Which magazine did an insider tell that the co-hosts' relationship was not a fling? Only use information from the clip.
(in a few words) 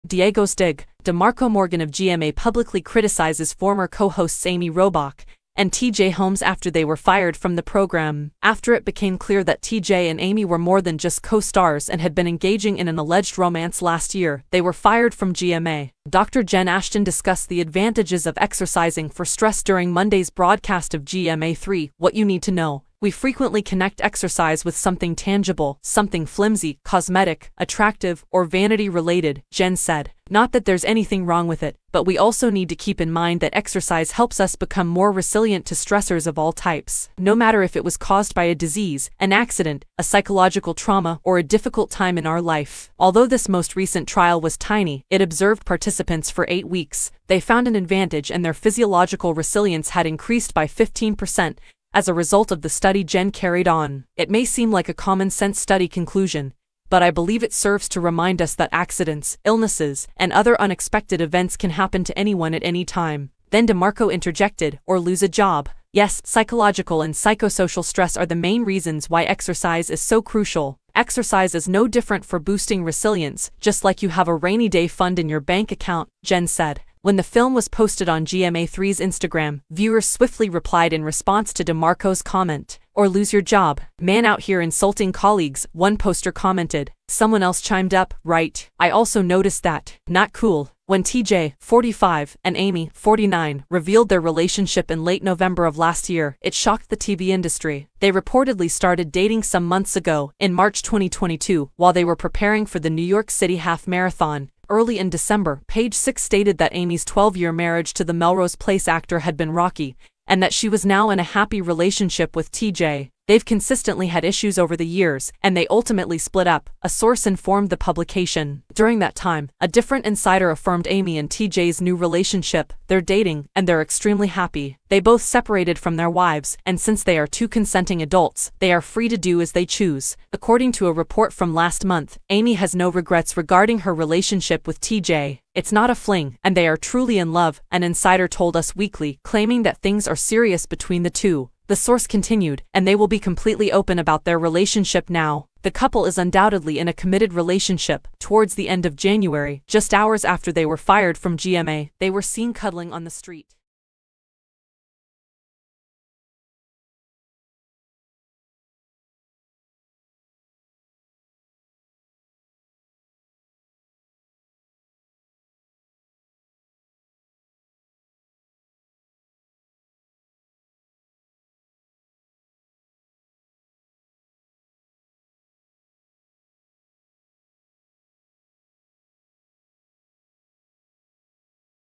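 Us Weekly.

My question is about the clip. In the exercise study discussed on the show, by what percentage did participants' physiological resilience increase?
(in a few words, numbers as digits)
15%.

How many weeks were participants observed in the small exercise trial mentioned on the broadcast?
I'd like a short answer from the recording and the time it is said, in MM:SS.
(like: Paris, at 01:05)
8, at 00:46.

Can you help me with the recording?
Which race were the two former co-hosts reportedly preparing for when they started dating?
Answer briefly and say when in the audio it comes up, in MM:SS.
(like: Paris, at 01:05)
New York City Half Marathon, at 01:42.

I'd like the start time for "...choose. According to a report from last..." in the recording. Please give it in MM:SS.
02:09.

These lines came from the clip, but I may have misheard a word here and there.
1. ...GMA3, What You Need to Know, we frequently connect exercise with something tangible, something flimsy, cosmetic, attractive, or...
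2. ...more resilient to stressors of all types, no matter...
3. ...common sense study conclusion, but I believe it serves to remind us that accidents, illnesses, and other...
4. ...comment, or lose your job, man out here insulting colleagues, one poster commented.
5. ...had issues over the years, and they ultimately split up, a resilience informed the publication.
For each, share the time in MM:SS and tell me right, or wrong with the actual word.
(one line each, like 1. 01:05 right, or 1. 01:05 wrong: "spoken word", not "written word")
1. 00:21 right
2. 00:34 right
3. 00:54 right
4. 01:22 right
5. 01:54 wrong: "source", not "resilience".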